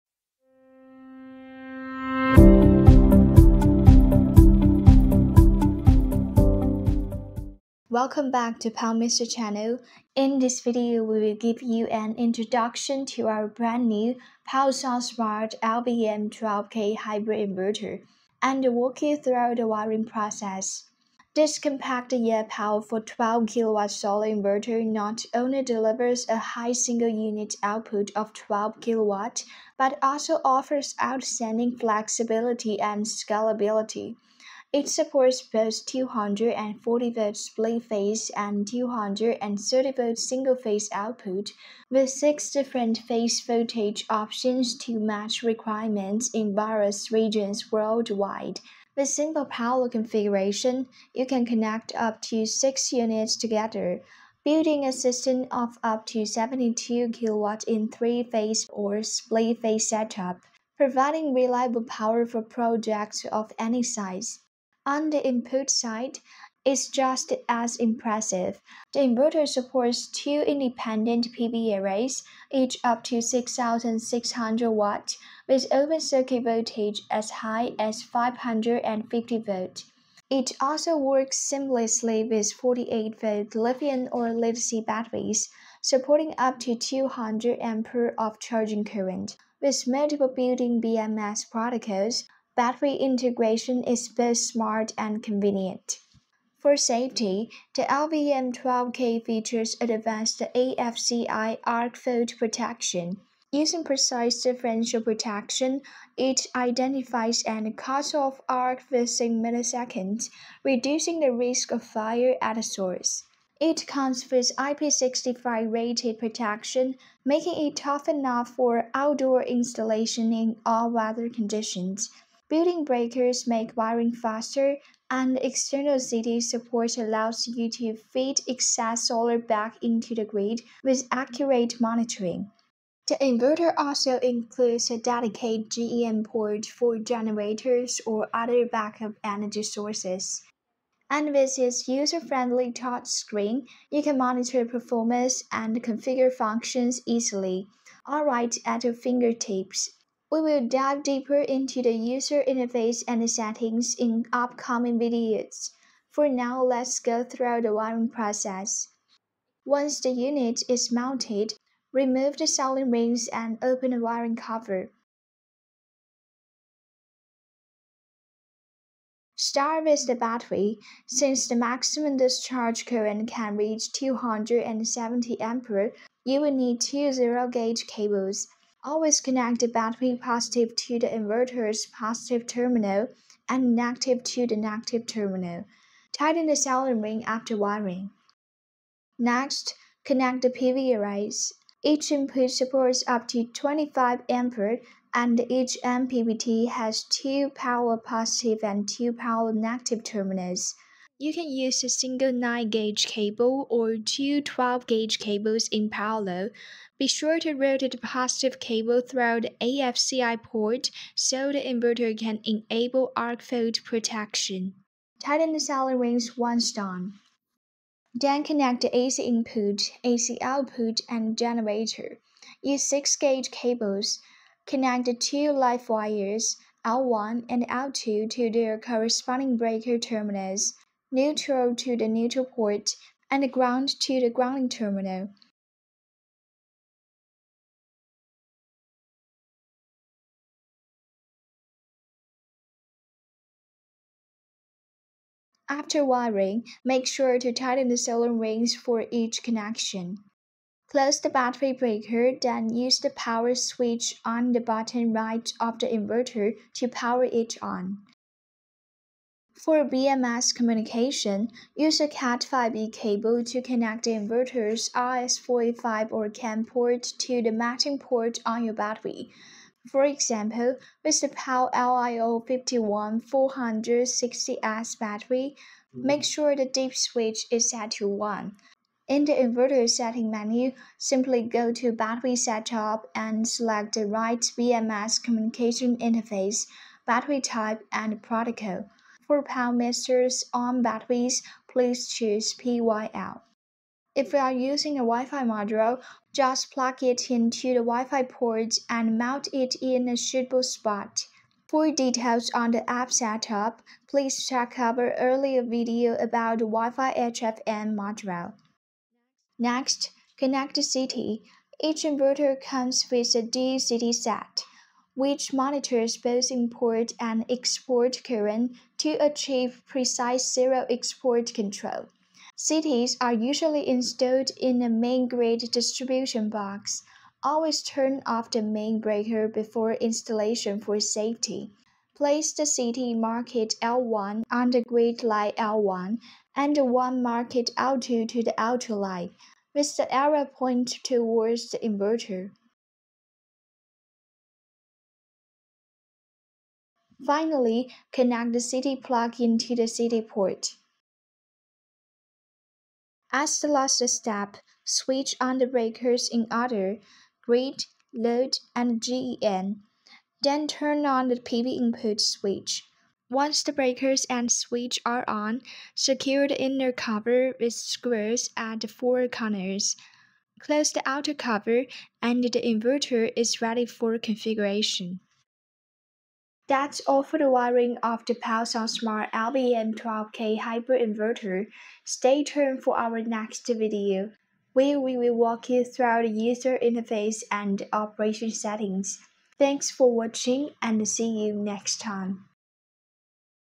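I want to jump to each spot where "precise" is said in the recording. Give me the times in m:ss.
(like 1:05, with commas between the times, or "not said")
1:43, 5:19.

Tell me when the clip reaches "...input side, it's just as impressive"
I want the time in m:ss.
1:05.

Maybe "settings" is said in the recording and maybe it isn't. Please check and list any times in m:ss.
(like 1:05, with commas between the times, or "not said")
2:33, 4:39, 6:28.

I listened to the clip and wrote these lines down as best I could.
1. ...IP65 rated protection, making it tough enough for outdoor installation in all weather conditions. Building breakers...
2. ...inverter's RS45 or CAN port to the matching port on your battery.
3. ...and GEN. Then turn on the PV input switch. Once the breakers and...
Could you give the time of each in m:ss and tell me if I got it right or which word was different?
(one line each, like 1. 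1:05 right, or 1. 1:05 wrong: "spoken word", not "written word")
1. 1:54 right
2. 4:24 right
3. 5:58 right.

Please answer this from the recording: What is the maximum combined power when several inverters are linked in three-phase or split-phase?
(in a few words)
72 kW.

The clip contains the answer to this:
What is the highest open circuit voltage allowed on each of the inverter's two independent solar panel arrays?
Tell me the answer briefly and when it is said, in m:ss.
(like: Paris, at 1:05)
550 volt, at 1:18.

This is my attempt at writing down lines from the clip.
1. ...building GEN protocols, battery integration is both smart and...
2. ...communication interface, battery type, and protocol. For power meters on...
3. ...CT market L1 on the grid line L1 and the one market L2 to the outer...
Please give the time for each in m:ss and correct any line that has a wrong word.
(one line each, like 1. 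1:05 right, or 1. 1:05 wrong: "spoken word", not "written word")
1. 1:30 wrong: "BMS", not "GEN"
2. 4:45 right
3. 5:32 right.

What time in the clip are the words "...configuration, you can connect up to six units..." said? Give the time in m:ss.
0:49.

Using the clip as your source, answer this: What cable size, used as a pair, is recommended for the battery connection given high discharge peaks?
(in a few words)
zero-gauge.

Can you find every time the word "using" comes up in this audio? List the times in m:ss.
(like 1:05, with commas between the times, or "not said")
1:43, 4:54.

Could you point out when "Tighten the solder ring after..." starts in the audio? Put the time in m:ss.
3:06.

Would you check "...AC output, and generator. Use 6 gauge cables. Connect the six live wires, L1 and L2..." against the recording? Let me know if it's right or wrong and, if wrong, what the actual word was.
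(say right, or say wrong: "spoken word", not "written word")
wrong: "two", not "six".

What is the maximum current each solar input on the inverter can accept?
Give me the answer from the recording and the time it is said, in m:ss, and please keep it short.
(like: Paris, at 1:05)
25 ampere, at 3:13.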